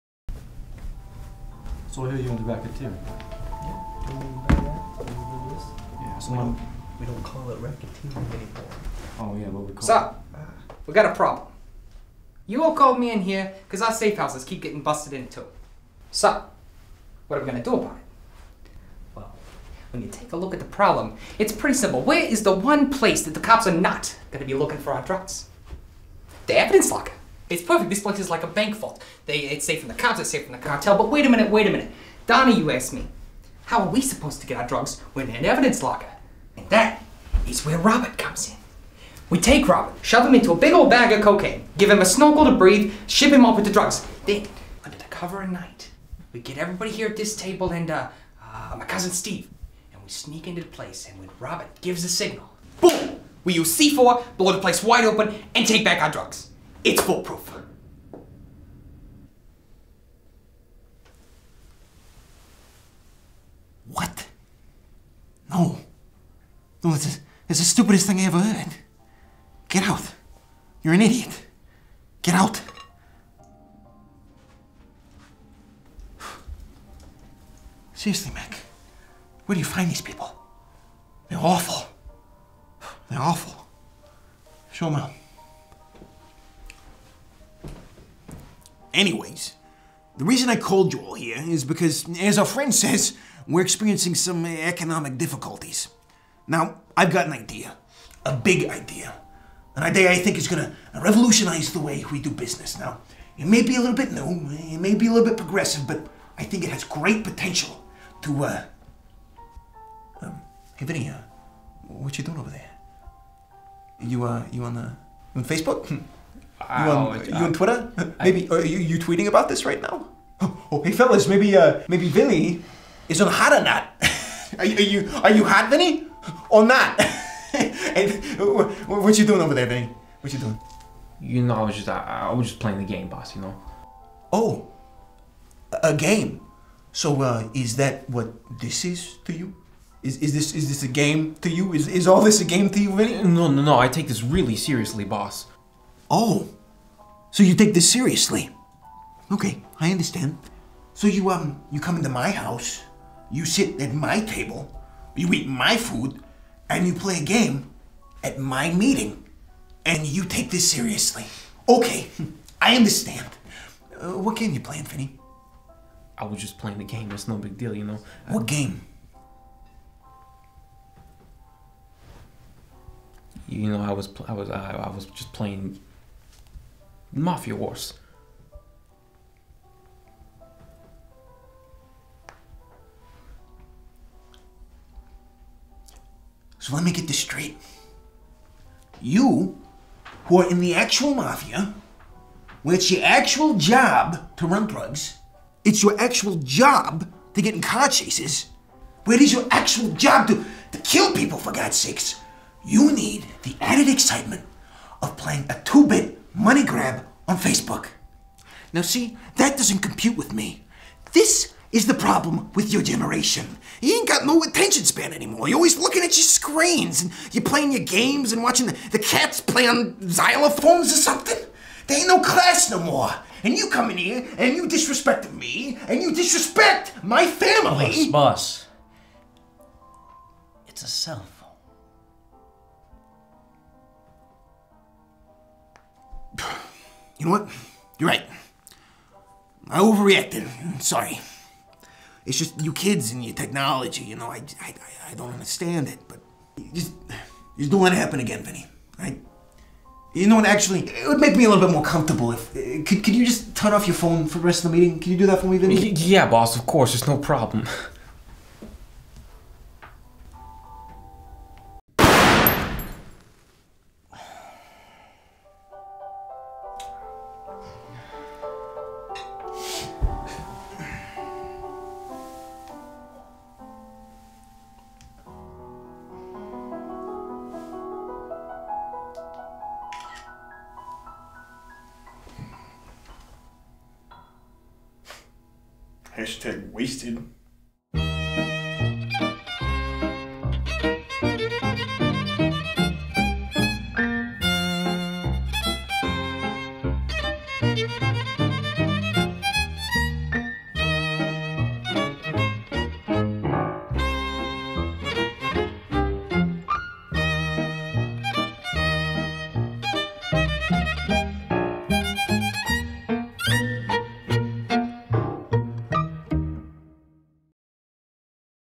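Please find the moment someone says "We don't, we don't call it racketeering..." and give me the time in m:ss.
0:06.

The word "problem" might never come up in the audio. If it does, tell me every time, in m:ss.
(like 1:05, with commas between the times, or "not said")
0:11, 0:20, 3:31, 4:17.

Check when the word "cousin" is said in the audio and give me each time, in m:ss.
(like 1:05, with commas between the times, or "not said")
0:48.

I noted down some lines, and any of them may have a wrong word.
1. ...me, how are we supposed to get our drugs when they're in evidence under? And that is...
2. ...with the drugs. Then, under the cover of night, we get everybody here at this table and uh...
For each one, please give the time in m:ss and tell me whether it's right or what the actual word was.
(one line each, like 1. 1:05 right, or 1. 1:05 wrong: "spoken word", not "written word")
1. 0:32 wrong: "locker", not "under"
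2. 0:43 right.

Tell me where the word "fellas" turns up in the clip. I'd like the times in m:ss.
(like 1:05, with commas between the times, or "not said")
2:00.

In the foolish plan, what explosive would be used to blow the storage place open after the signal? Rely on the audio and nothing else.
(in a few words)
C4.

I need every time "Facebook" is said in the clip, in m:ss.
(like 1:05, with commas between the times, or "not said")
1:55, 3:27.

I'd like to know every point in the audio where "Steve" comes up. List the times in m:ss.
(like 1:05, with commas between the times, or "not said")
0:49.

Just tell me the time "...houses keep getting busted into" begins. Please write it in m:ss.
0:14.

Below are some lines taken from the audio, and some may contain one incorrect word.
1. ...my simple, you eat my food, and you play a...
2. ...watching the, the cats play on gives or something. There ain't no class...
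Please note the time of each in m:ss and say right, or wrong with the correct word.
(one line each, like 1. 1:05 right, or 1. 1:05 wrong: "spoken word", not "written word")
1. 2:33 wrong: "table", not "simple"
2. 3:38 wrong: "xylophones", not "gives".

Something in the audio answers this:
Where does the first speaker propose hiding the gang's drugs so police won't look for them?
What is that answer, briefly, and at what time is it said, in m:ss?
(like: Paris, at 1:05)
The evidence locker, at 0:26.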